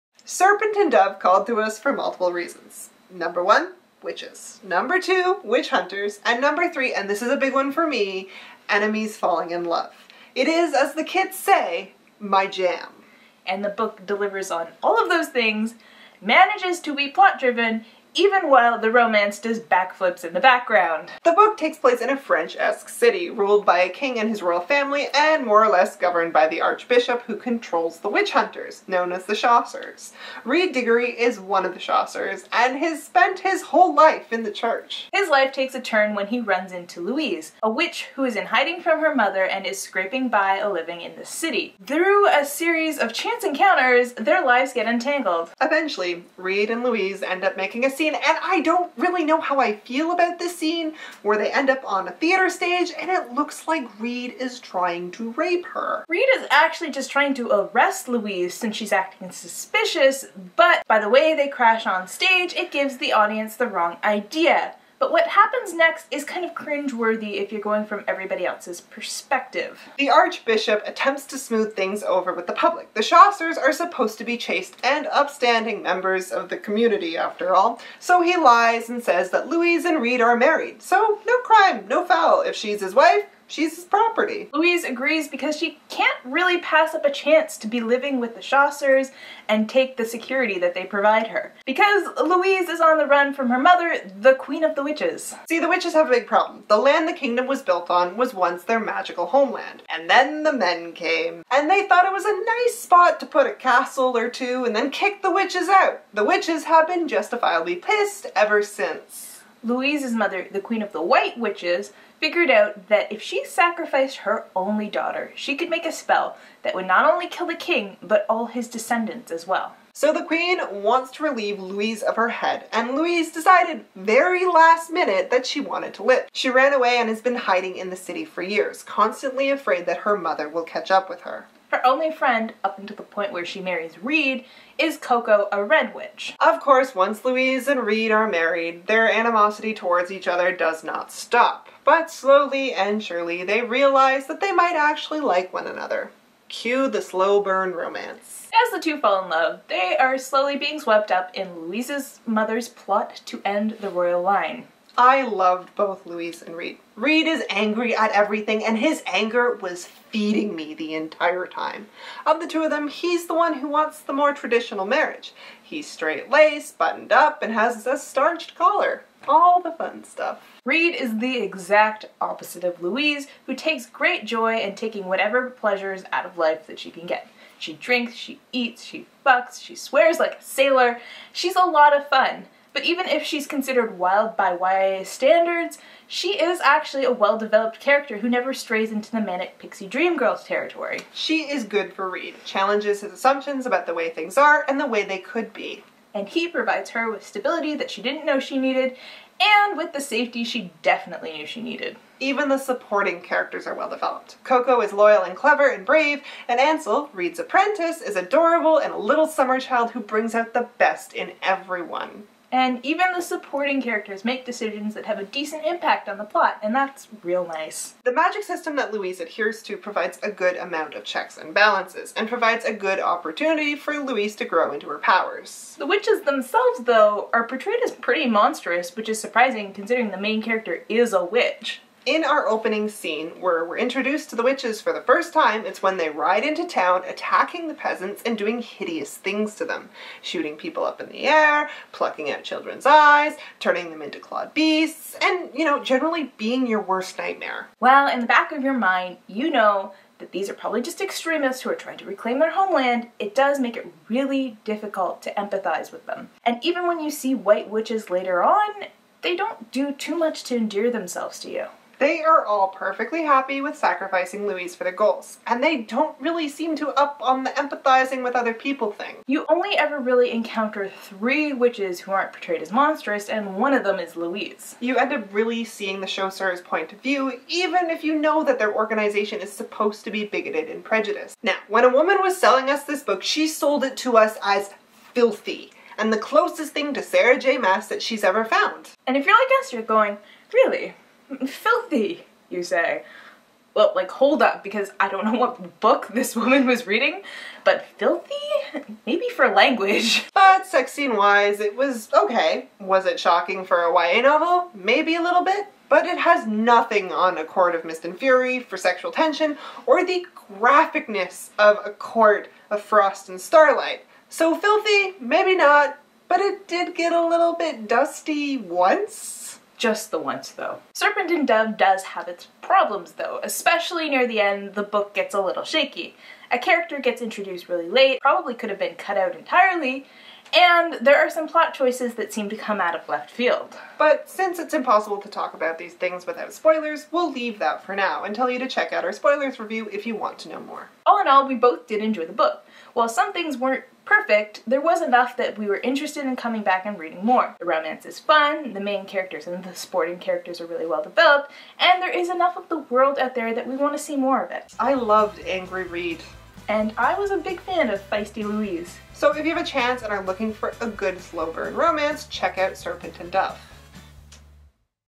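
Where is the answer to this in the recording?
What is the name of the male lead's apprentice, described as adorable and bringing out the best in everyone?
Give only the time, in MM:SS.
03:26.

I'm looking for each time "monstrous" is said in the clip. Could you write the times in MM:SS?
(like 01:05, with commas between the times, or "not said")
03:48, 04:32.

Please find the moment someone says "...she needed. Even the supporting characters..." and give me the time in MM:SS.
03:21.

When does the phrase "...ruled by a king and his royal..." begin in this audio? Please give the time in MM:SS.
00:23.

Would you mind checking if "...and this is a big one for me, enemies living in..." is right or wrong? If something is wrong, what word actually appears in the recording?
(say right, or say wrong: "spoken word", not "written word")
wrong: "falling", not "living".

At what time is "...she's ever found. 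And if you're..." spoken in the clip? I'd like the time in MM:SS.
04:48.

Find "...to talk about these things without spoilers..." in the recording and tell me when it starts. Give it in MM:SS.
05:35.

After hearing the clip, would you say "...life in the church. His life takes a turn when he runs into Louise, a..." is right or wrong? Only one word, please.
right.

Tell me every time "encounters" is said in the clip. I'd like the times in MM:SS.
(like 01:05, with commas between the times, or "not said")
00:43, 04:30.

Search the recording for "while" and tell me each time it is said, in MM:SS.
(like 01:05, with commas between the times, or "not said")
00:18, 05:42.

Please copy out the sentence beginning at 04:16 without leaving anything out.
And even when you see white witches later on, they don't do too much to endear themselves to you.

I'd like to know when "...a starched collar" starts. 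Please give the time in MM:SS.
02:47.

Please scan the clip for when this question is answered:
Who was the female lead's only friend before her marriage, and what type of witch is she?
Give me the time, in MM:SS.
02:14.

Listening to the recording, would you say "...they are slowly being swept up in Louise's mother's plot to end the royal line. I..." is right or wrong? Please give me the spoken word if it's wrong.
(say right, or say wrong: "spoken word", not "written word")
right.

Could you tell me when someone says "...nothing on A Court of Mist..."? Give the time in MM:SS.
05:06.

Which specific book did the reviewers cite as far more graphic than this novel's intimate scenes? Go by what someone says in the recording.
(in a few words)
A Court of Frost and Starlight.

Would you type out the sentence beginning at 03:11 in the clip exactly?
She is good for Reid, challenges his assumptions about the way things are and the way they could be.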